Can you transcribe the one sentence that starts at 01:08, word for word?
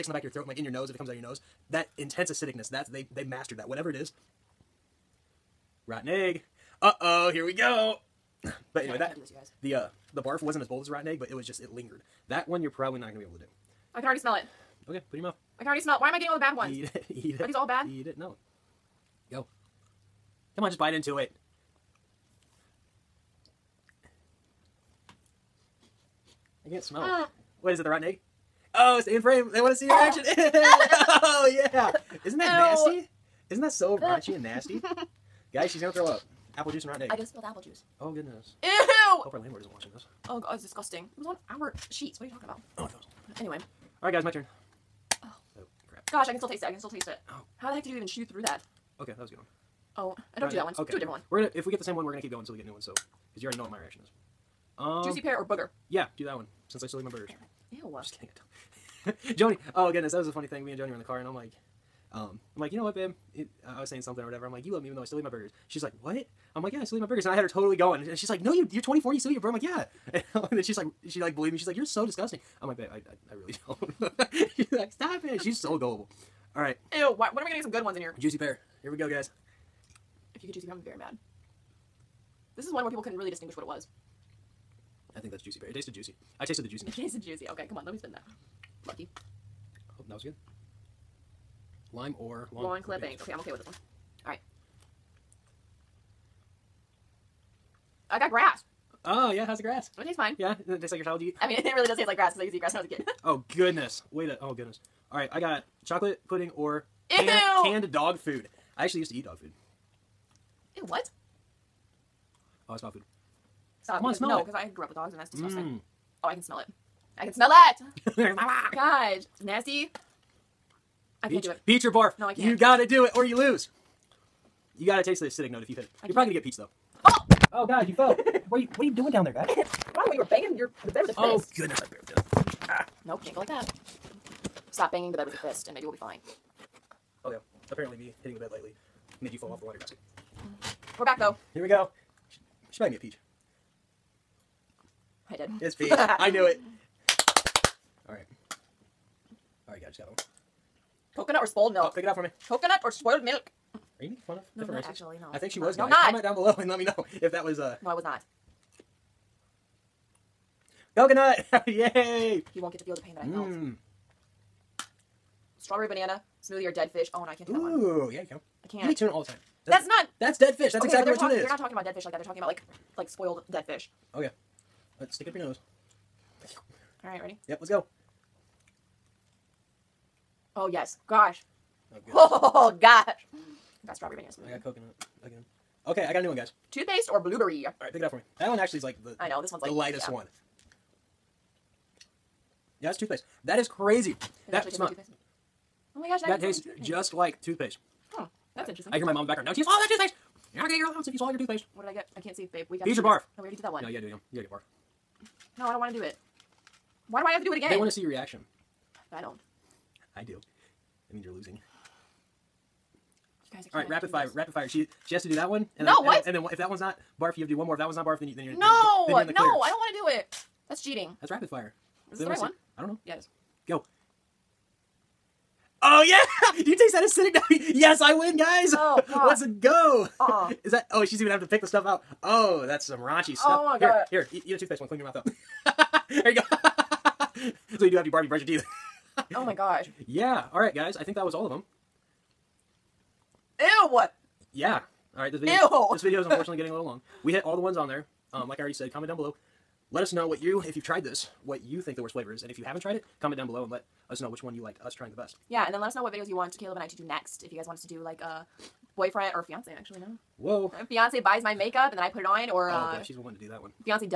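And she's like, no, you, you're 24, you still eat your burger.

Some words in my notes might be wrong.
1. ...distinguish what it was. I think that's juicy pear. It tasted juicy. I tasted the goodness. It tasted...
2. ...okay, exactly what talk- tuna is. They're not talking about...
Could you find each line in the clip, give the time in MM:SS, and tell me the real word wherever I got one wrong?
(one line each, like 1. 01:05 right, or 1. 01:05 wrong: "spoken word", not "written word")
1. 01:23 wrong: "juiciness", not "goodness"
2. 02:50 right.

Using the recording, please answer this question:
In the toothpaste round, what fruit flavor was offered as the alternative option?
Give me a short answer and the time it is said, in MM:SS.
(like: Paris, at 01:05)
Blueberry, at 03:07.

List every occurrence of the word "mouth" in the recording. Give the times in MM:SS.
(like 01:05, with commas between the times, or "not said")
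00:15, 03:55.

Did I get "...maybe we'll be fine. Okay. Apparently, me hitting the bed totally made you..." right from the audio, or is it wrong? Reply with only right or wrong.
wrong.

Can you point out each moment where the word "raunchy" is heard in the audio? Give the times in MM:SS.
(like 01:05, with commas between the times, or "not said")
00:33, 03:52.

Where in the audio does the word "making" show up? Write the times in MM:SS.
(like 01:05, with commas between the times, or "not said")
02:34.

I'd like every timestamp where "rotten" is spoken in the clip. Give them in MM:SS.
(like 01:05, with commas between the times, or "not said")
00:05, 00:10, 00:27, 00:36.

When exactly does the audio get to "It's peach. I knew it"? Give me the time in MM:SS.
02:25.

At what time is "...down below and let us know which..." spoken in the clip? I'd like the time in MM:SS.
04:13.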